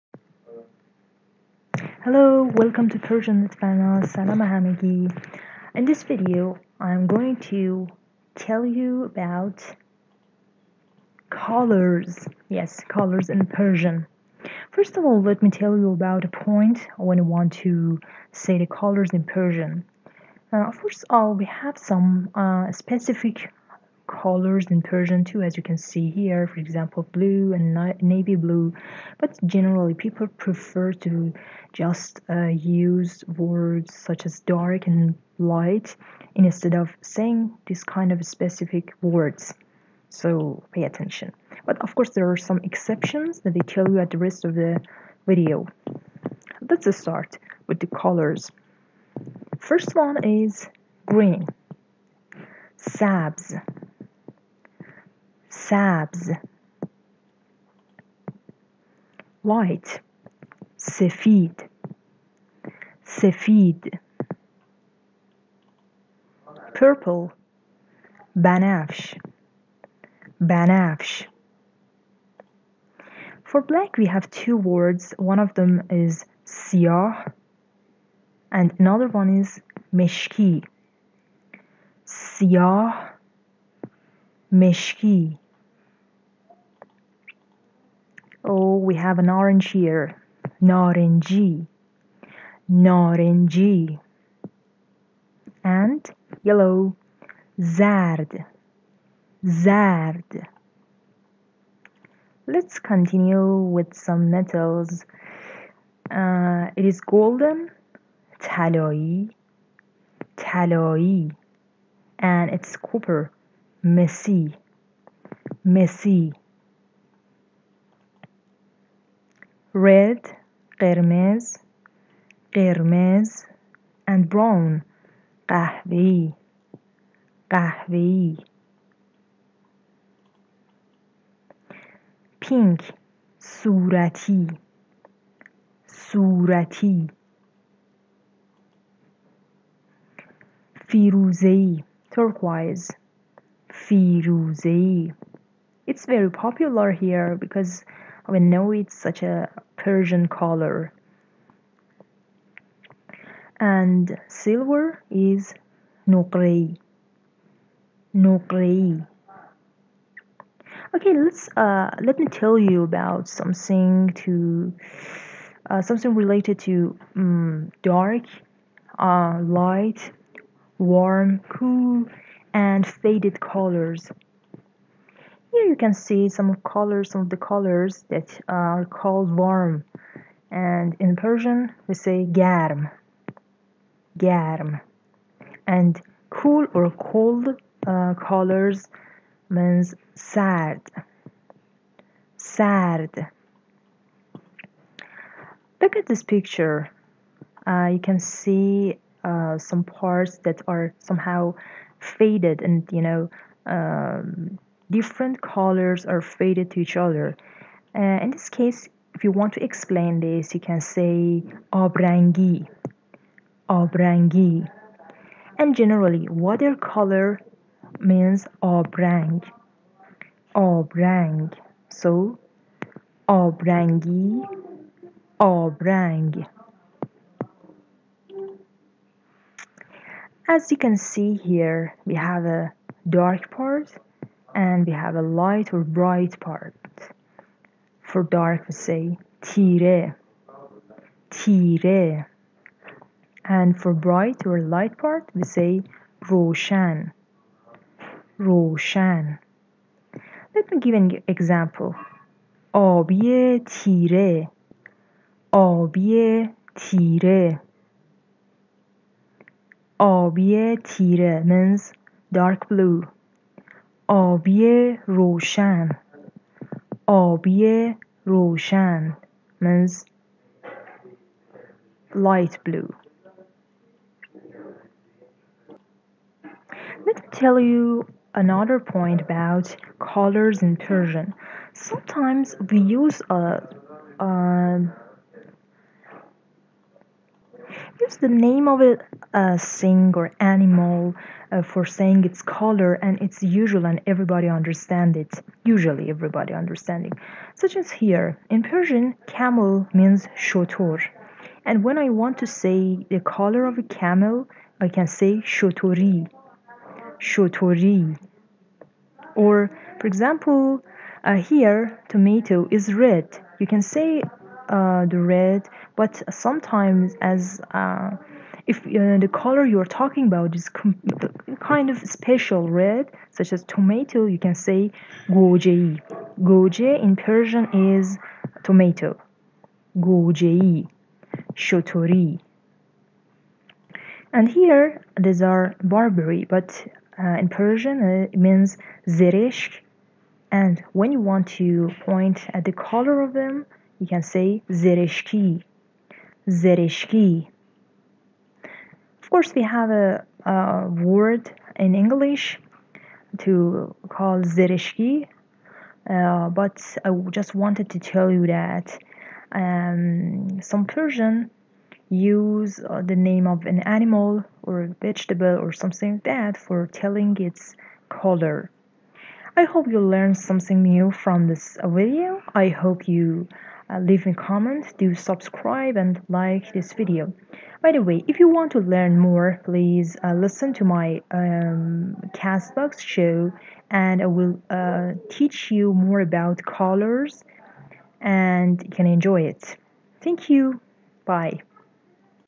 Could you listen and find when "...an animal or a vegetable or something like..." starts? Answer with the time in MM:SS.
06:03.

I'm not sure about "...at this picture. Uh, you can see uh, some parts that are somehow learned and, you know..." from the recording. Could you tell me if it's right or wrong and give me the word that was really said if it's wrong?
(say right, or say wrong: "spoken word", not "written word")
wrong: "faded", not "learned".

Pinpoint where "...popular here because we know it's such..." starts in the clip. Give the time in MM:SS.
02:26.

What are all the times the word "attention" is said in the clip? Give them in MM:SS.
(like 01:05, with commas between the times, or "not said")
00:40.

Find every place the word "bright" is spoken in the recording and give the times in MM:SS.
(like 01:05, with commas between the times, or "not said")
03:55, 04:03.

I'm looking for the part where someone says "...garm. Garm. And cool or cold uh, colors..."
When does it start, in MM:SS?
03:02.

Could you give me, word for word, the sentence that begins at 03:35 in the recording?
And generally, water color means abrang, abrang.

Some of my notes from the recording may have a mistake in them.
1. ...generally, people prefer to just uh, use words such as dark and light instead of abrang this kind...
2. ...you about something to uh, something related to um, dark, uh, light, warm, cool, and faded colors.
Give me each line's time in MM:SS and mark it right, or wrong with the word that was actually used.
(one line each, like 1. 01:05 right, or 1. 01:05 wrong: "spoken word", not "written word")
1. 00:29 wrong: "saying", not "abrang"
2. 02:42 right.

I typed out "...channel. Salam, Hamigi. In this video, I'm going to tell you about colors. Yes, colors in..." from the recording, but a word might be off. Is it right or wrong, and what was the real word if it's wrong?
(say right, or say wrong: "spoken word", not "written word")
right.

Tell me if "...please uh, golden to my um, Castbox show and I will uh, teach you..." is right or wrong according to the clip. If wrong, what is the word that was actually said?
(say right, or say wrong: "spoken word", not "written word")
wrong: "listen", not "golden".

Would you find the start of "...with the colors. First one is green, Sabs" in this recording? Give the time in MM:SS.
00:47.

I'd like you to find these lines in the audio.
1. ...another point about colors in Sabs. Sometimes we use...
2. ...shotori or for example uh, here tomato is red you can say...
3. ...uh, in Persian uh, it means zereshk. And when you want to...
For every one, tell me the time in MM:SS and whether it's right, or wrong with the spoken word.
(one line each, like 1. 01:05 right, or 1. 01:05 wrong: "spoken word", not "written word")
1. 04:38 wrong: "Persian", not "Sabs"
2. 05:07 right
3. 05:37 right.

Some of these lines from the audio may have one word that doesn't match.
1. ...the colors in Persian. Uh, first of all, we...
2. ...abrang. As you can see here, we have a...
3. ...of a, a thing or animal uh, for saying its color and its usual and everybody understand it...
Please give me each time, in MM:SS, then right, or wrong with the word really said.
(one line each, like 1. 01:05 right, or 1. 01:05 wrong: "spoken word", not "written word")
1. 00:18 right
2. 03:45 right
3. 04:48 right.